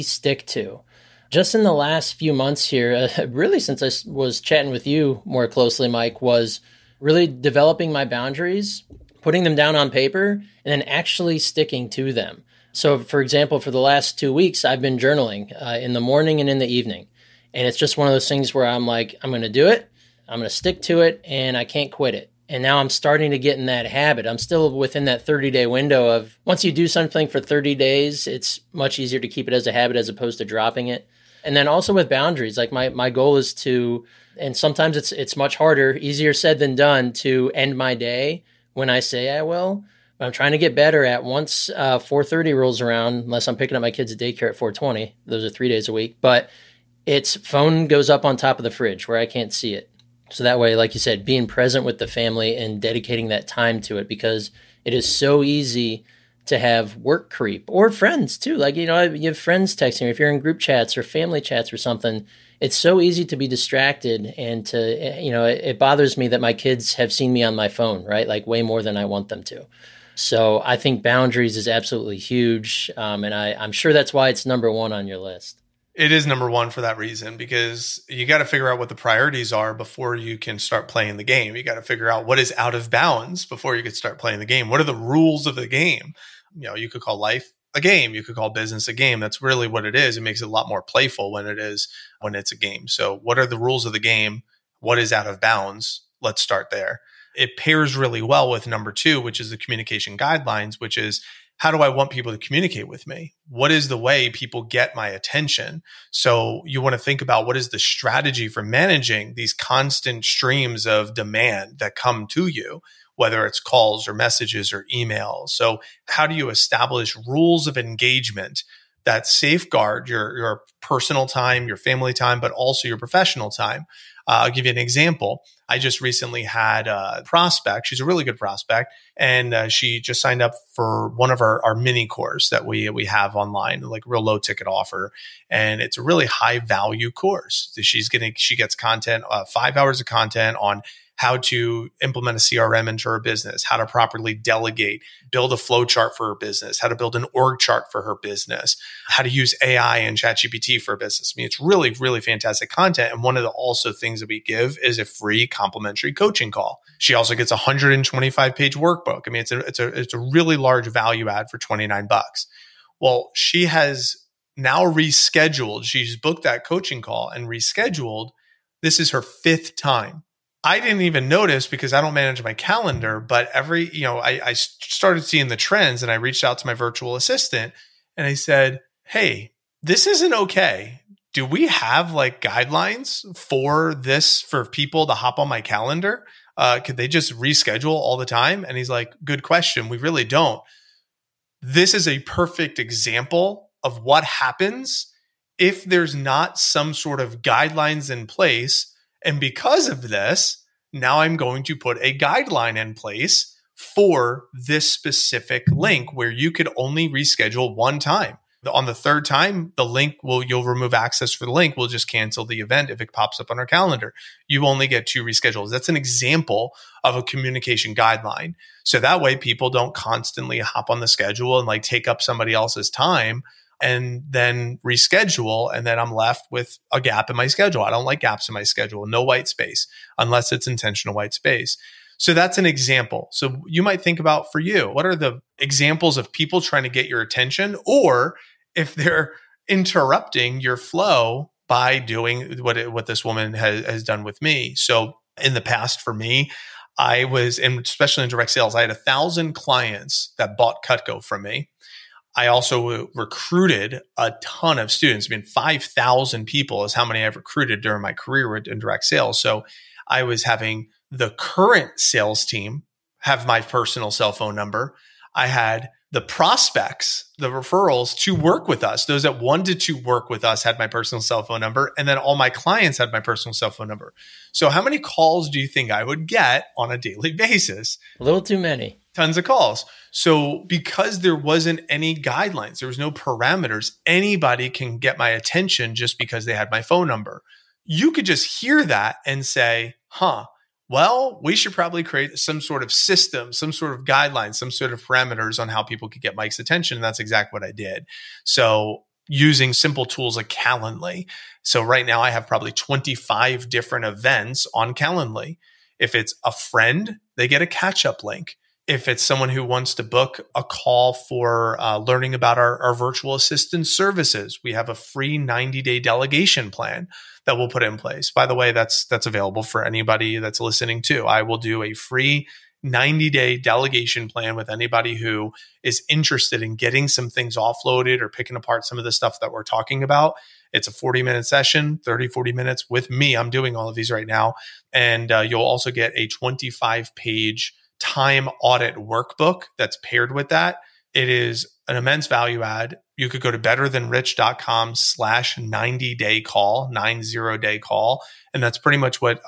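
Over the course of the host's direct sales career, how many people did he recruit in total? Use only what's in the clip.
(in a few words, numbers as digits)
5,000.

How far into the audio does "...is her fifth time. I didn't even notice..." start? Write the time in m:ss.
2:48.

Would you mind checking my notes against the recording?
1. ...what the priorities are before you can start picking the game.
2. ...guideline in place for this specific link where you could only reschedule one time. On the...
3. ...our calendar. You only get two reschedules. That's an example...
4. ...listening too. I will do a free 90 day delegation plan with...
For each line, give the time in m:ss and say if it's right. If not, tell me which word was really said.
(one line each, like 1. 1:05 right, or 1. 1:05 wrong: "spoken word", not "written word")
1. 1:18 wrong: "playing", not "picking"
2. 3:22 right
3. 3:33 right
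4. 5:20 right.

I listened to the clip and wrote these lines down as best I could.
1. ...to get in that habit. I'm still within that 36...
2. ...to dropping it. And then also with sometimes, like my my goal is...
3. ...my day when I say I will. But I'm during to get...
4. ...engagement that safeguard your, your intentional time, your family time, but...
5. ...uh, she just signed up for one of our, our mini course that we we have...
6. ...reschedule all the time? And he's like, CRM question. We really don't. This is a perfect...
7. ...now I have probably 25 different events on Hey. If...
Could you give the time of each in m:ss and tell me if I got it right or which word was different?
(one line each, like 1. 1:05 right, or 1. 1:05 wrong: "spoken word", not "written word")
1. 0:23 wrong: "30", not "36"
2. 0:30 wrong: "boundaries", not "sometimes"
3. 0:37 wrong: "trying", not "during"
4. 1:57 wrong: "personal", not "intentional"
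5. 2:09 right
6. 3:07 wrong: "Good", not "CRM"
7. 5:02 wrong: "Calendly", not "Hey".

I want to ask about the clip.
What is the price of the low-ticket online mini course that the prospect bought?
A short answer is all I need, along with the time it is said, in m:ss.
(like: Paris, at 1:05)
$29, at 2:41.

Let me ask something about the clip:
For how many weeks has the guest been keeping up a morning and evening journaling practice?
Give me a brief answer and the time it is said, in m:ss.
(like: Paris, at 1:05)
2, at 0:14.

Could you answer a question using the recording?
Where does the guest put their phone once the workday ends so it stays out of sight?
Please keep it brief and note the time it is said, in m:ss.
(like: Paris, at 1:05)
On top of the fridge, at 0:48.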